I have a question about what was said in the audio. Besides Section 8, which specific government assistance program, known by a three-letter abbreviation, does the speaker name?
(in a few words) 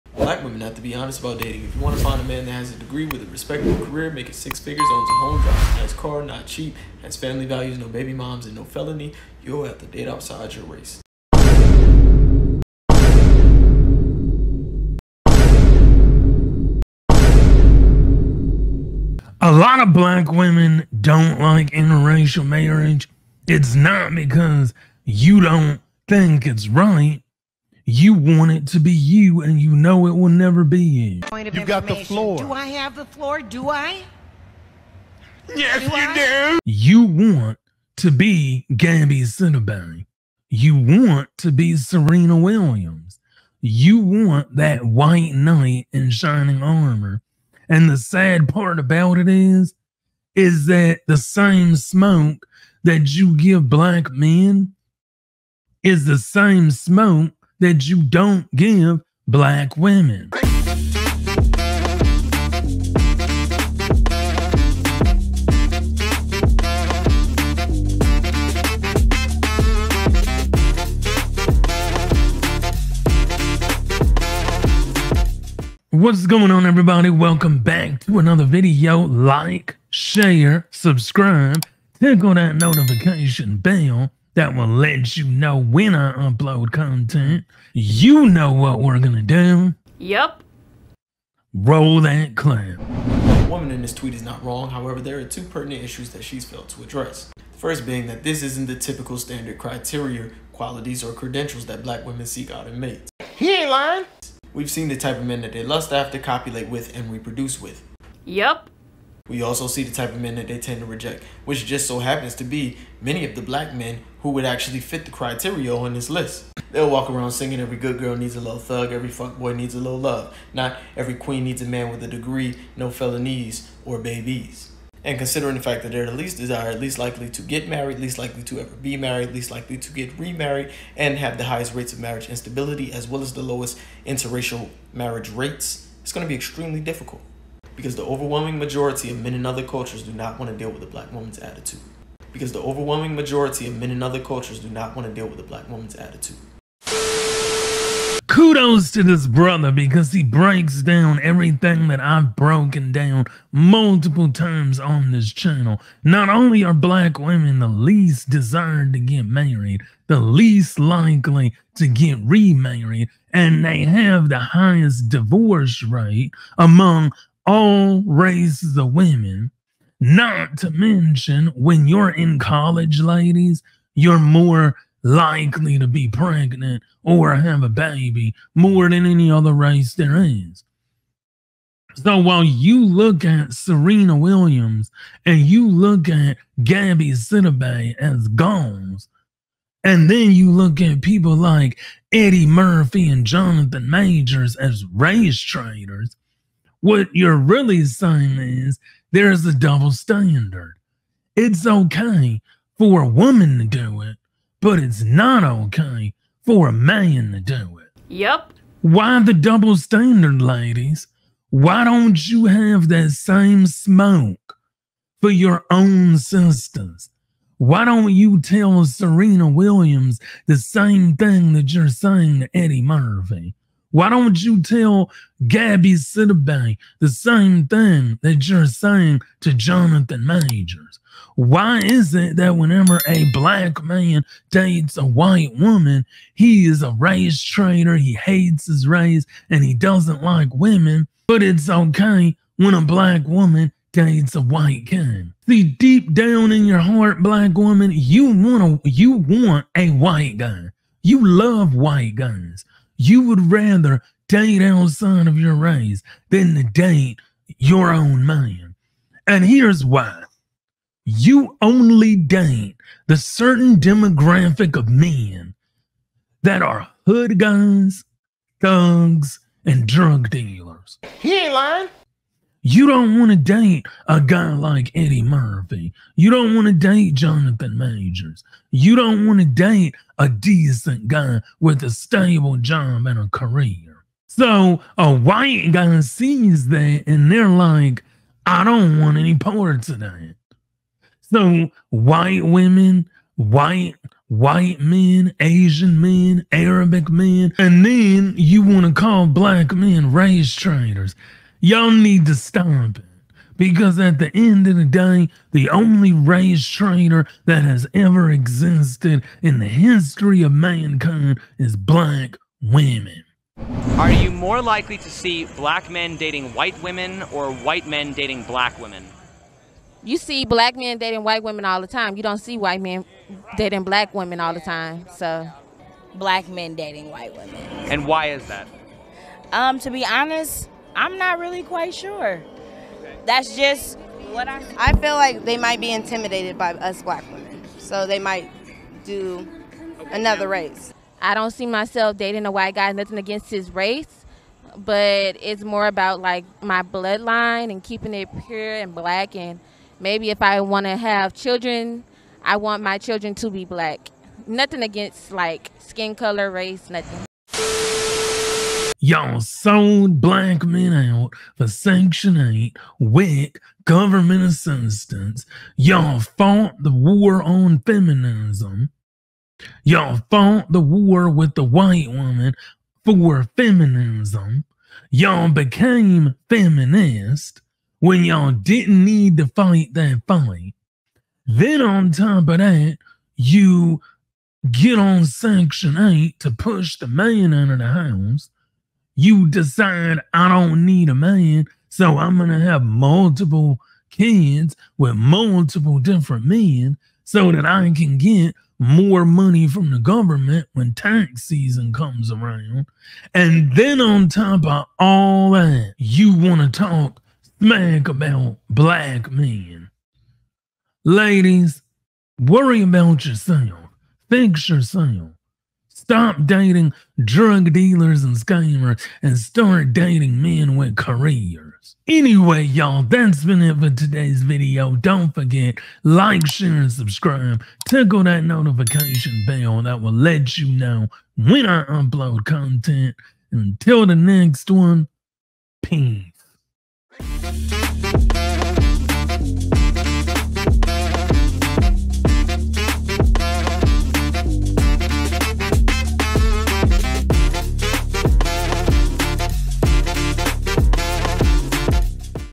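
WIC.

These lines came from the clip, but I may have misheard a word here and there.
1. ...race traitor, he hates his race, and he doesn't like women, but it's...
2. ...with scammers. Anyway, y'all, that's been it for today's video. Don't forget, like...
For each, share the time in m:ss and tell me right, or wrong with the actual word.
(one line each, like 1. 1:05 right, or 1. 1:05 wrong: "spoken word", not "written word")
1. 3:56 right
2. 7:00 wrong: "careers", not "scammers".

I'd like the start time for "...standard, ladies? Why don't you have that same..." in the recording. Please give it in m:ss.
3:29.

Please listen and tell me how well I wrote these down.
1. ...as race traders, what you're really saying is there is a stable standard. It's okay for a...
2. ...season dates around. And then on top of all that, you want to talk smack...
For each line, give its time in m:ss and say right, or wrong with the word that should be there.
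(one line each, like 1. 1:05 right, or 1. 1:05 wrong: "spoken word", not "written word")
1. 3:14 wrong: "double", not "stable"
2. 6:41 wrong: "comes", not "dates".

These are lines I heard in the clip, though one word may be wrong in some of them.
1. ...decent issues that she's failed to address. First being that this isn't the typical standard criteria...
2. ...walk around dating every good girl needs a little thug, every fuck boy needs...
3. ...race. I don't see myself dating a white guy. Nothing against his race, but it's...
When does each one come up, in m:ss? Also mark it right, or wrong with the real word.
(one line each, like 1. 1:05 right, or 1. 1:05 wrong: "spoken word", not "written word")
1. 1:35 wrong: "pertinent", not "decent"
2. 1:56 wrong: "singing", not "dating"
3. 5:40 right.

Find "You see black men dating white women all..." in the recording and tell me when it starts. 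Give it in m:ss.
5:20.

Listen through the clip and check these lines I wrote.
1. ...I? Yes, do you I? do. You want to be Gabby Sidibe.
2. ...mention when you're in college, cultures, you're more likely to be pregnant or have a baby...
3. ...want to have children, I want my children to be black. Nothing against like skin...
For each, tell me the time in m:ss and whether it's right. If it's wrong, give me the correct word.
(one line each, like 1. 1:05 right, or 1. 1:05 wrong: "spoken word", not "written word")
1. 0:33 right
2. 2:50 wrong: "ladies", not "cultures"
3. 5:50 right.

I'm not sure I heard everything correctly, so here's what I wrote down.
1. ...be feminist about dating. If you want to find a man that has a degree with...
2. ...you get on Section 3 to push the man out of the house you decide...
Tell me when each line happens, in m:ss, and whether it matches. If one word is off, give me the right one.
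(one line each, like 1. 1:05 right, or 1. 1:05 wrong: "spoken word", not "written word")
1. 0:00 wrong: "honest", not "feminist"
2. 6:23 wrong: "8", not "3".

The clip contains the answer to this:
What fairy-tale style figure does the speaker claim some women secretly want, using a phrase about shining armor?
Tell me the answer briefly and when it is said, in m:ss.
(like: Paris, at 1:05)
White knight, at 0:44.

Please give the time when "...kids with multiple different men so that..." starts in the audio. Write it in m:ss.
6:34.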